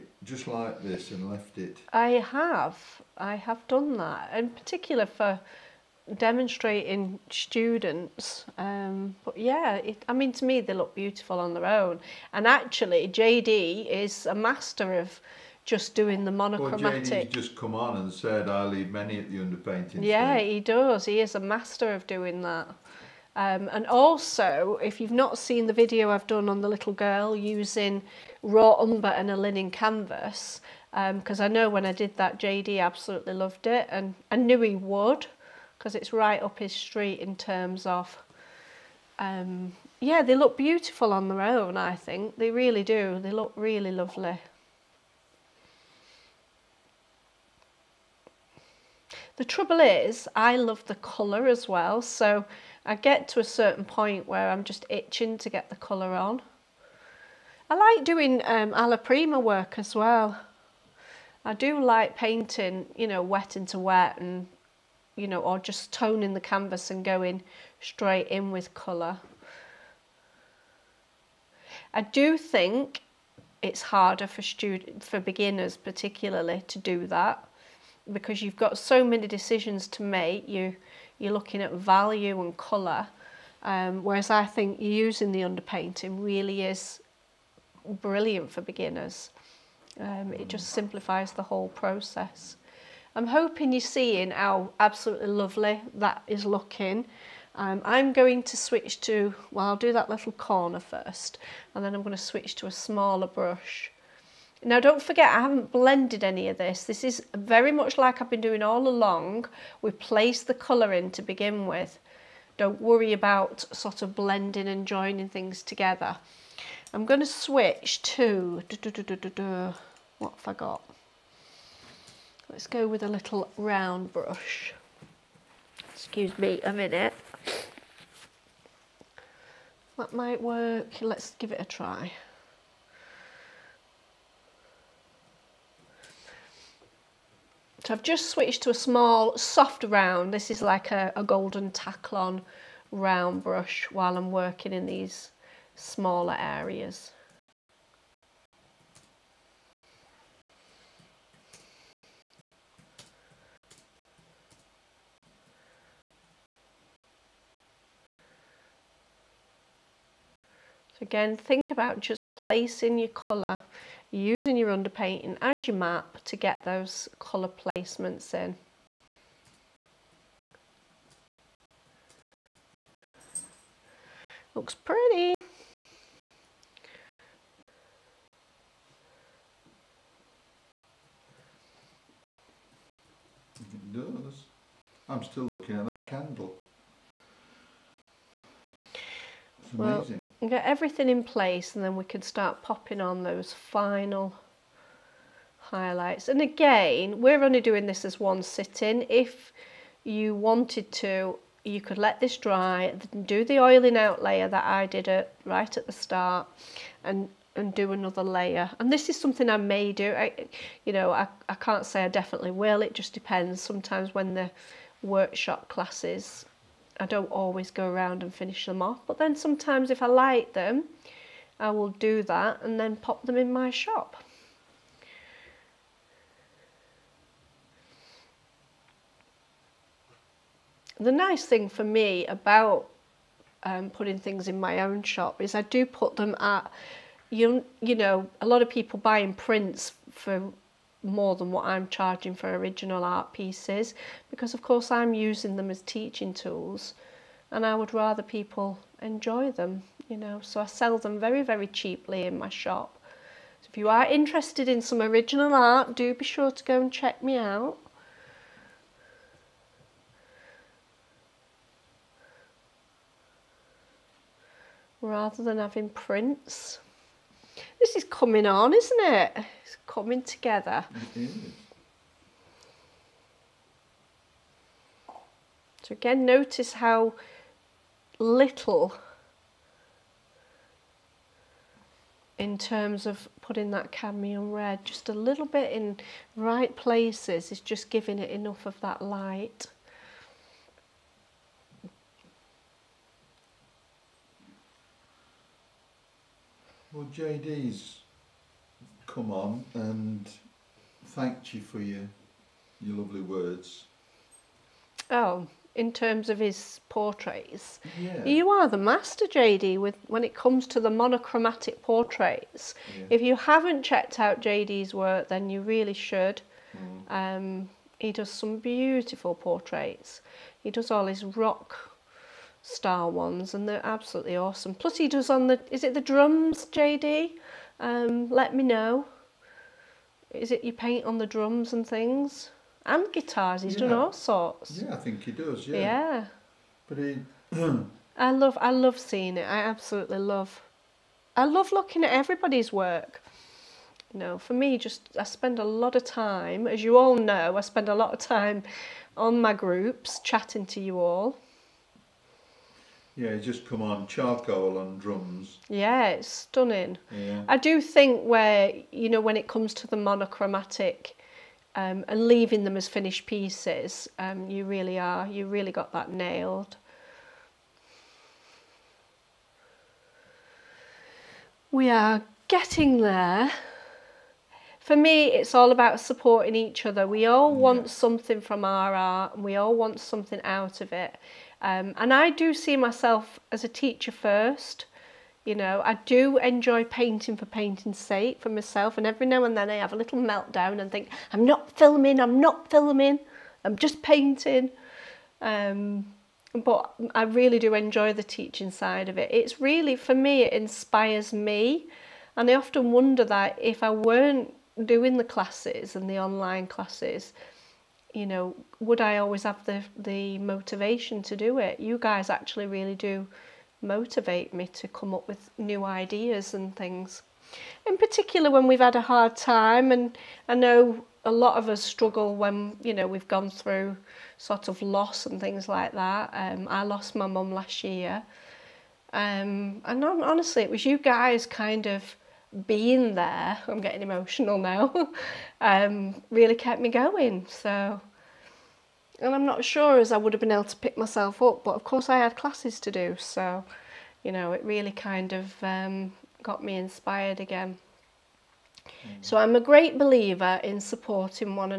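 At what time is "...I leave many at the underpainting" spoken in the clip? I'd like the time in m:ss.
0:18.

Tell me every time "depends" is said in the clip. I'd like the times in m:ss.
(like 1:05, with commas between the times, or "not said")
3:33.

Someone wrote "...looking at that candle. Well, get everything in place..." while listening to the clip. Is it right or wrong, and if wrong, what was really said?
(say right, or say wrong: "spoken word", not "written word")
right.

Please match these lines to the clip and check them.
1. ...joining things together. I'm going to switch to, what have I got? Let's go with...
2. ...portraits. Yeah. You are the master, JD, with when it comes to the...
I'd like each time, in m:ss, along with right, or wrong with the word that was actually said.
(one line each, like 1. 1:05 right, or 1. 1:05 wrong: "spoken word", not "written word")
1. 1:54 right
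2. 5:06 right.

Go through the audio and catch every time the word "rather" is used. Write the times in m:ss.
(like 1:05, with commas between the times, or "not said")
4:07, 4:25.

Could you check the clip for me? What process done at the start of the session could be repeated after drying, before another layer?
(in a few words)
Oiling out.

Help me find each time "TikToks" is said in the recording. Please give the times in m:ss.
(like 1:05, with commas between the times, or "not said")
not said.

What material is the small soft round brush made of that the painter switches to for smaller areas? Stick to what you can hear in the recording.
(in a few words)
Golden Taklon.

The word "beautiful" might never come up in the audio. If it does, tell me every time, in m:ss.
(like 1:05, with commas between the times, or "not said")
0:10, 0:40, 5:18.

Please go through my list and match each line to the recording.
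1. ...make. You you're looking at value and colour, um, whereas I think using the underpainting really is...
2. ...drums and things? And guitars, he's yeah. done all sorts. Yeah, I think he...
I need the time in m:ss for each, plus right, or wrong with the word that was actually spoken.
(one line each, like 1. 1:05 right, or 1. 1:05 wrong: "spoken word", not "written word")
1. 1:20 right
2. 5:31 right.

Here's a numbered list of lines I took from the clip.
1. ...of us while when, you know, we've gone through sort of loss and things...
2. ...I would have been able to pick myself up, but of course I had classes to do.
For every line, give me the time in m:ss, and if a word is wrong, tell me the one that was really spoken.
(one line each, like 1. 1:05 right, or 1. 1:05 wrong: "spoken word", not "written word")
1. 7:01 wrong: "struggle", not "while"
2. 7:20 right.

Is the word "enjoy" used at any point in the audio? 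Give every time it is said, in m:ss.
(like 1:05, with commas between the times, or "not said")
4:09, 6:26, 6:37.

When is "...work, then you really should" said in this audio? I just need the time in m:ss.
5:14.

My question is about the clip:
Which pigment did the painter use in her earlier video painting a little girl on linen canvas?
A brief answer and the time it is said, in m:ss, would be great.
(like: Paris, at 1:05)
Raw umber, at 0:28.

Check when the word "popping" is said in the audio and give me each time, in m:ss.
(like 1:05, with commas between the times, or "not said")
3:12.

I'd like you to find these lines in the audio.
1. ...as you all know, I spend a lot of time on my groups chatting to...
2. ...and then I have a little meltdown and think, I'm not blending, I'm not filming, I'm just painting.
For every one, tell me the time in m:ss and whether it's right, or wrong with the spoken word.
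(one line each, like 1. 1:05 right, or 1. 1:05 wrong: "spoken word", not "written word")
1. 5:46 right
2. 6:29 wrong: "filming", not "blending".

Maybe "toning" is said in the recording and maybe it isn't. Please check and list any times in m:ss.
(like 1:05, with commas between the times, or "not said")
1:05.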